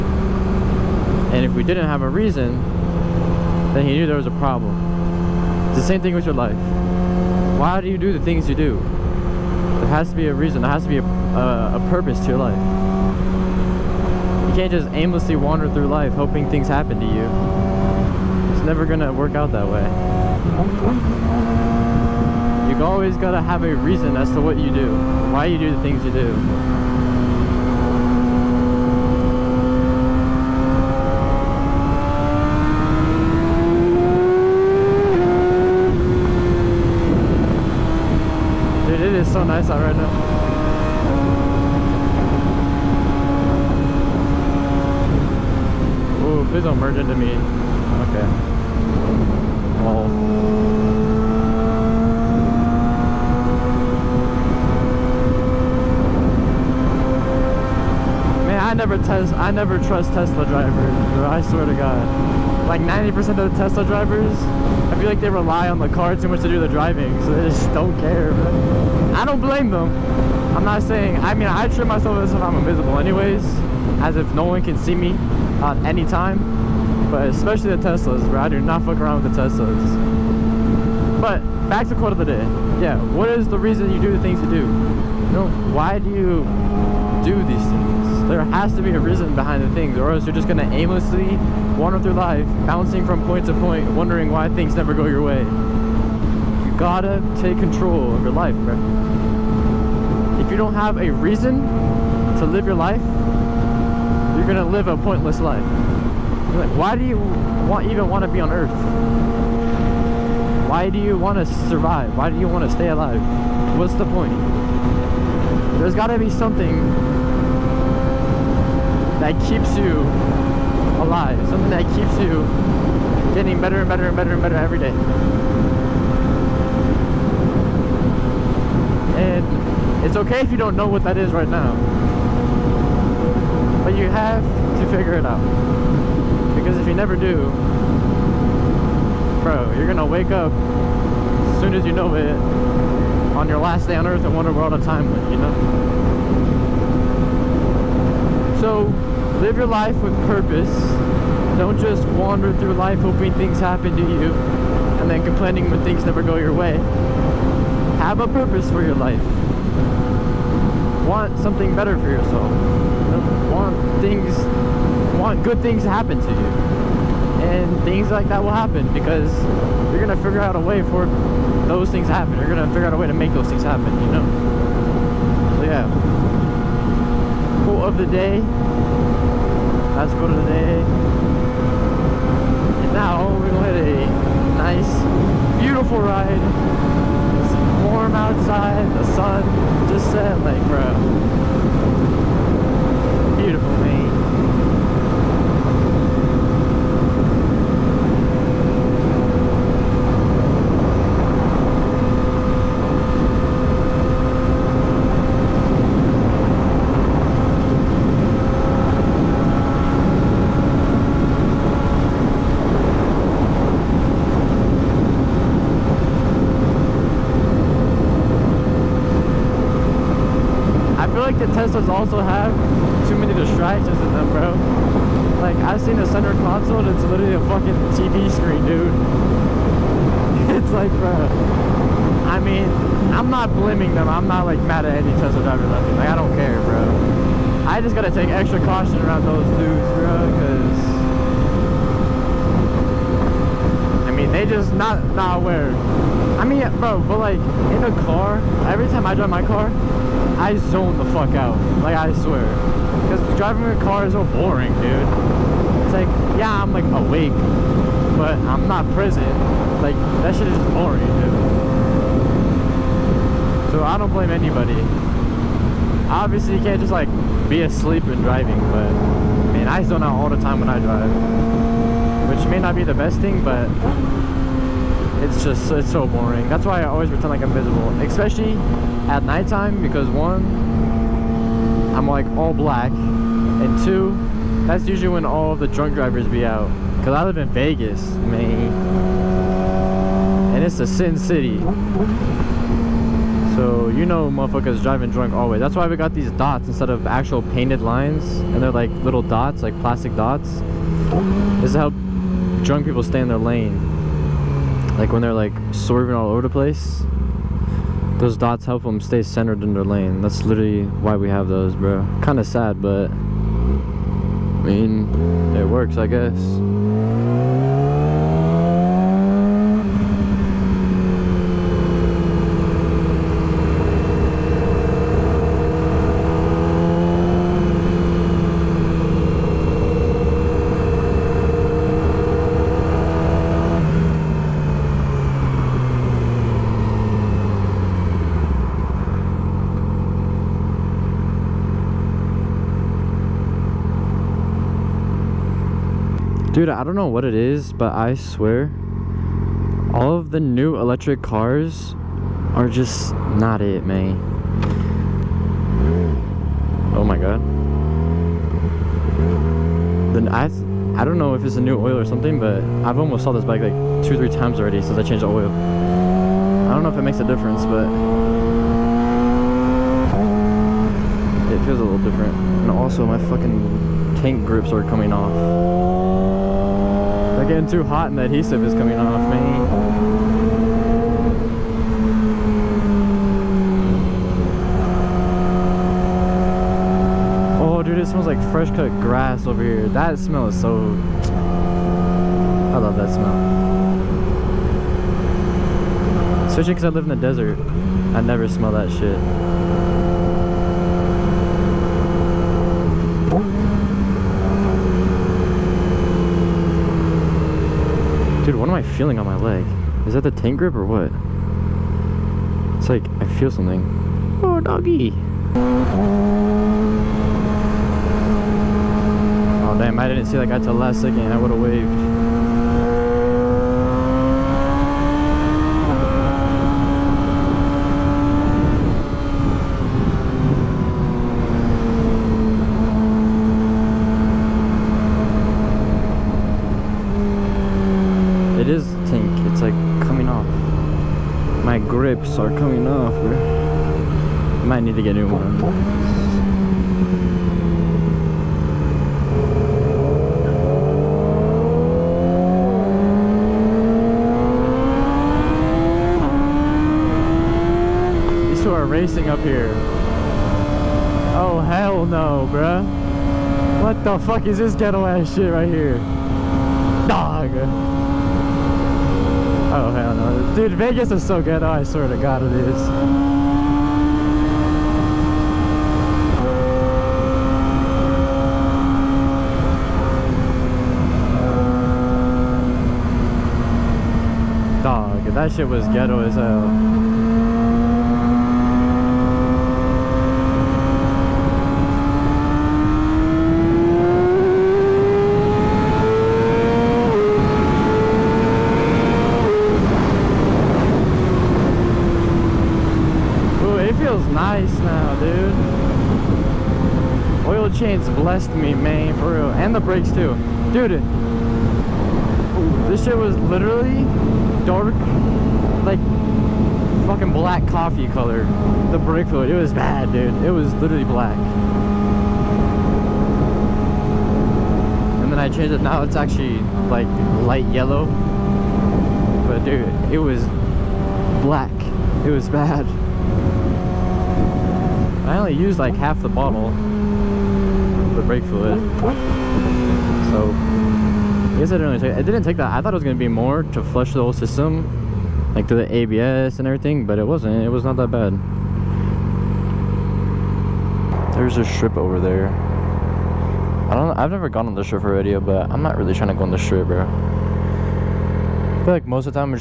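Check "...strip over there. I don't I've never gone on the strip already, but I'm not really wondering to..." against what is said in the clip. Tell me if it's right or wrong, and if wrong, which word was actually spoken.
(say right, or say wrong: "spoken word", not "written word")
wrong: "trying", not "wondering".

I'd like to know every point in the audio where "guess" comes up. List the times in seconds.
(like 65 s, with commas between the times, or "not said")
316 s, 541 s.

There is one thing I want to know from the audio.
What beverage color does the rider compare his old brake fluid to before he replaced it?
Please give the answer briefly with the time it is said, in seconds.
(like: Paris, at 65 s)
Black coffee, at 517 s.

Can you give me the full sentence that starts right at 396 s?
Especially because I live in the desert.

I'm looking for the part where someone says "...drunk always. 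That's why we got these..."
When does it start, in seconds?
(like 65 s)
295 s.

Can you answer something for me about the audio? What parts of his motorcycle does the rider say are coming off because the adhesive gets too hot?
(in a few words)
Tank grips.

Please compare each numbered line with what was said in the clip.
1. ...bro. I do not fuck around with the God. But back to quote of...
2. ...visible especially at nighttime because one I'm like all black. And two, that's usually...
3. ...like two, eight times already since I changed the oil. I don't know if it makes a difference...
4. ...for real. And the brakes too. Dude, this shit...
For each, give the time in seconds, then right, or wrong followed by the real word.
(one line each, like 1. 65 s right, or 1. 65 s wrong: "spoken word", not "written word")
1. 78 s wrong: "Teslas", not "God"
2. 277 s right
3. 363 s wrong: "three", not "eight"
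4. 509 s right.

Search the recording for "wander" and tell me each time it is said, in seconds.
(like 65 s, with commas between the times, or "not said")
15 s, 91 s, 152 s.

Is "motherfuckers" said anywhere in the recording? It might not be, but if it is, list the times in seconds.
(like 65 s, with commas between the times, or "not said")
294 s.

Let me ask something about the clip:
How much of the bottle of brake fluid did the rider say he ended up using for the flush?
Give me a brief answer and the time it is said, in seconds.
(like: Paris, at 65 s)
Half the bottle, at 535 s.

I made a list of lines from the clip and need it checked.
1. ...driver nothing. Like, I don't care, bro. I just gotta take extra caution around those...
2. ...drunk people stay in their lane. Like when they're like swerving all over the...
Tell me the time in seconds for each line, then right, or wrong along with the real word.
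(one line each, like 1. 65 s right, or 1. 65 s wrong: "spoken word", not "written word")
1. 235 s right
2. 302 s right.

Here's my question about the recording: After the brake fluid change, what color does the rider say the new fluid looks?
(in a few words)
Light yellow.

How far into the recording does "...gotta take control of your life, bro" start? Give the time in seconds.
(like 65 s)
96 s.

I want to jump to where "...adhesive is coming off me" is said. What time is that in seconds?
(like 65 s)
378 s.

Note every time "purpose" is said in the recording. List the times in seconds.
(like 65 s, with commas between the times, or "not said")
11 s, 150 s, 158 s.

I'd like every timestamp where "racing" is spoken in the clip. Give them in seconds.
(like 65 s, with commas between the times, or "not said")
458 s.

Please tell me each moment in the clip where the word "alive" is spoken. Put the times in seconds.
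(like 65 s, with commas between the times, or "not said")
112 s, 121 s.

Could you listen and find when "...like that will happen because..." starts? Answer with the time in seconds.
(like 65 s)
168 s.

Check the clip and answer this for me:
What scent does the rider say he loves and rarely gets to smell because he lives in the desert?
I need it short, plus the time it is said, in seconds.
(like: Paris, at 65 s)
Fresh cut grass, at 388 s.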